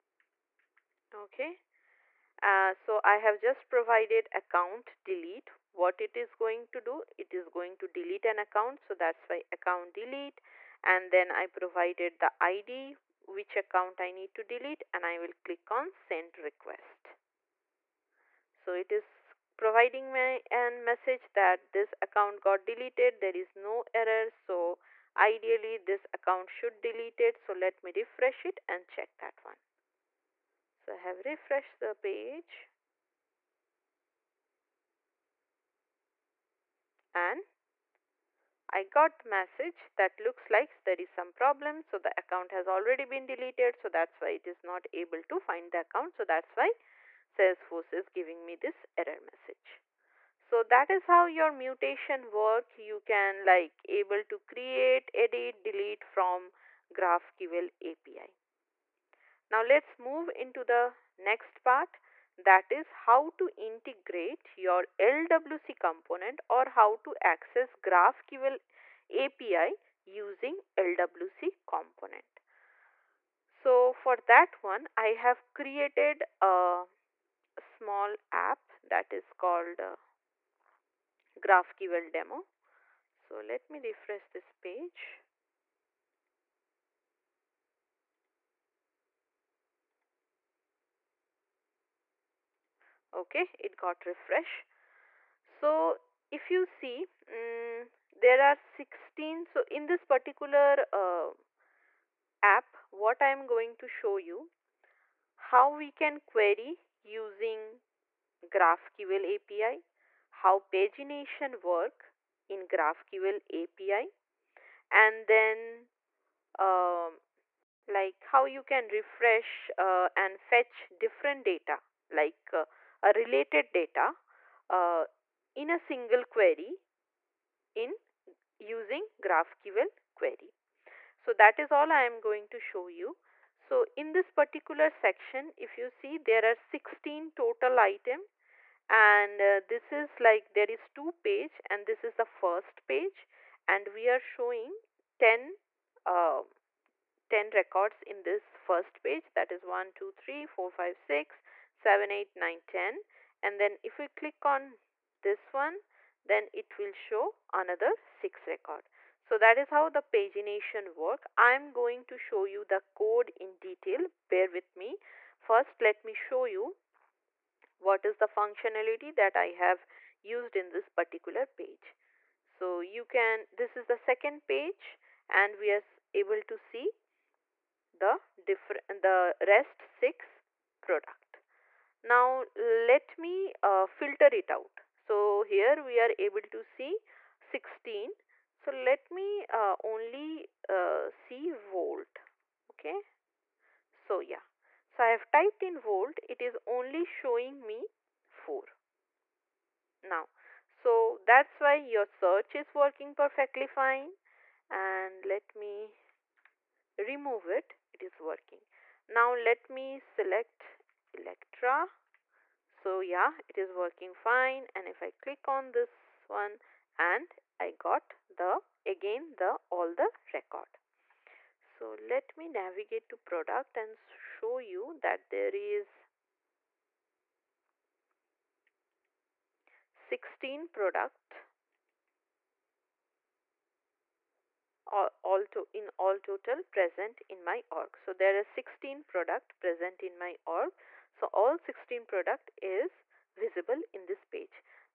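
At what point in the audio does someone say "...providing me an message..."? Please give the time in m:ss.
0:19.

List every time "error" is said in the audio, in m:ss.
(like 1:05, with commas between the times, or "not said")
0:23, 0:48.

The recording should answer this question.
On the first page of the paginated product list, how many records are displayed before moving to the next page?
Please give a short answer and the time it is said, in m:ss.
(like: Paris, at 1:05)
10, at 2:25.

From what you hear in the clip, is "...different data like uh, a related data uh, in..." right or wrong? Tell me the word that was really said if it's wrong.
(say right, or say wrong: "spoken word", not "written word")
right.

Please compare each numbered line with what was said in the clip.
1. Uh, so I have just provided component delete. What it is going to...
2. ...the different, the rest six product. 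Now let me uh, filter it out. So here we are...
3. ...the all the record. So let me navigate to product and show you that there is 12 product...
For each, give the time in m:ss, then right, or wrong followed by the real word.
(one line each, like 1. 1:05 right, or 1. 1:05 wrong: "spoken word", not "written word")
1. 0:02 wrong: "account", not "component"
2. 2:57 right
3. 3:39 wrong: "16", not "12".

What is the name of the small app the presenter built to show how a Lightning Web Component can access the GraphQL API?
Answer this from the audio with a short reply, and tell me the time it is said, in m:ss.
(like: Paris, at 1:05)
GraphQL demo, at 1:21.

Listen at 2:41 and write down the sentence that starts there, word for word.
I'm going to show you the code in detail.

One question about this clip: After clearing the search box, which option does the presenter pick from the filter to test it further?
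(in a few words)
Electra.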